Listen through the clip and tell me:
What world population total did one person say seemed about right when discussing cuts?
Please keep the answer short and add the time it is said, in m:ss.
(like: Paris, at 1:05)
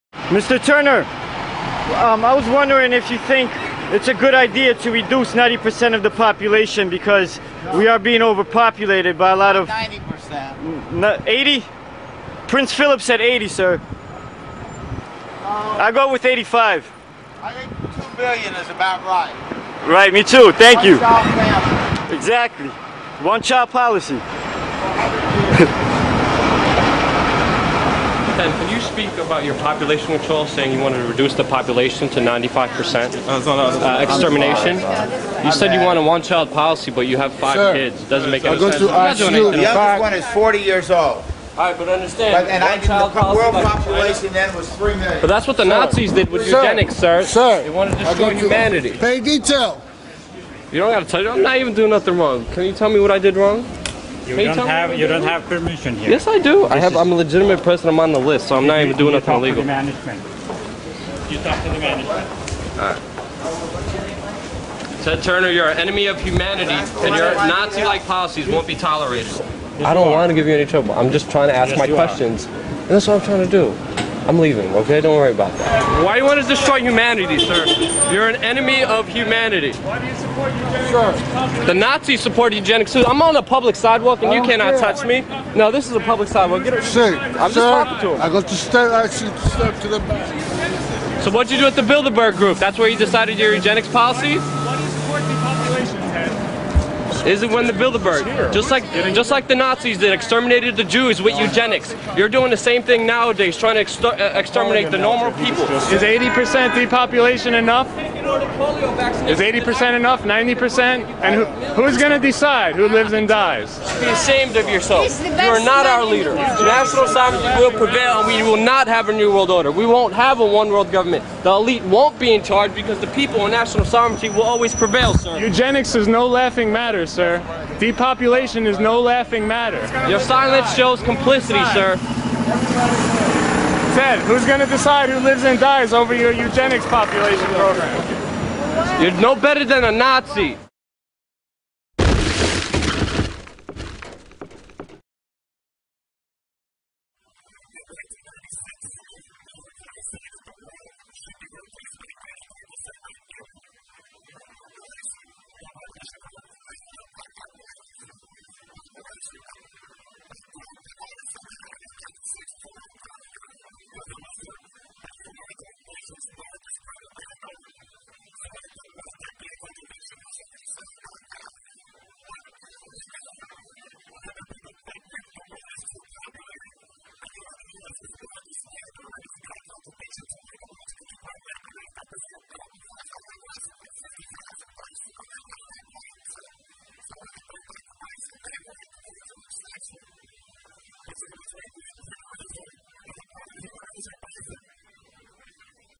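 2 billion, at 0:18.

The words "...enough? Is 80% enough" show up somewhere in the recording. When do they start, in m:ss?
1:47.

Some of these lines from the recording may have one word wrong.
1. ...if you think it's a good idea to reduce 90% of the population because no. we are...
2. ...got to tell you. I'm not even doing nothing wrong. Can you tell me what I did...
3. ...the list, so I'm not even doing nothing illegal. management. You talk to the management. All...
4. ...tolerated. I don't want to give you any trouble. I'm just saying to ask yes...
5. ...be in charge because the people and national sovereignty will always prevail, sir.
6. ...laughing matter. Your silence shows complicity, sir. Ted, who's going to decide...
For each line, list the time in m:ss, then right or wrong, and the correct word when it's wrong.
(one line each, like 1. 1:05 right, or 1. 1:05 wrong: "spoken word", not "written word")
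1. 0:02 right
2. 0:50 right
3. 0:58 right
4. 1:08 wrong: "trying", not "saying"
5. 2:02 right
6. 2:09 right.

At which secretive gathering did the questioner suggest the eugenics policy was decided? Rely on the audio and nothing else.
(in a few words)
Bilderberg group.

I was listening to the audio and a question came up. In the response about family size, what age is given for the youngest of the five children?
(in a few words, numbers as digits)
40.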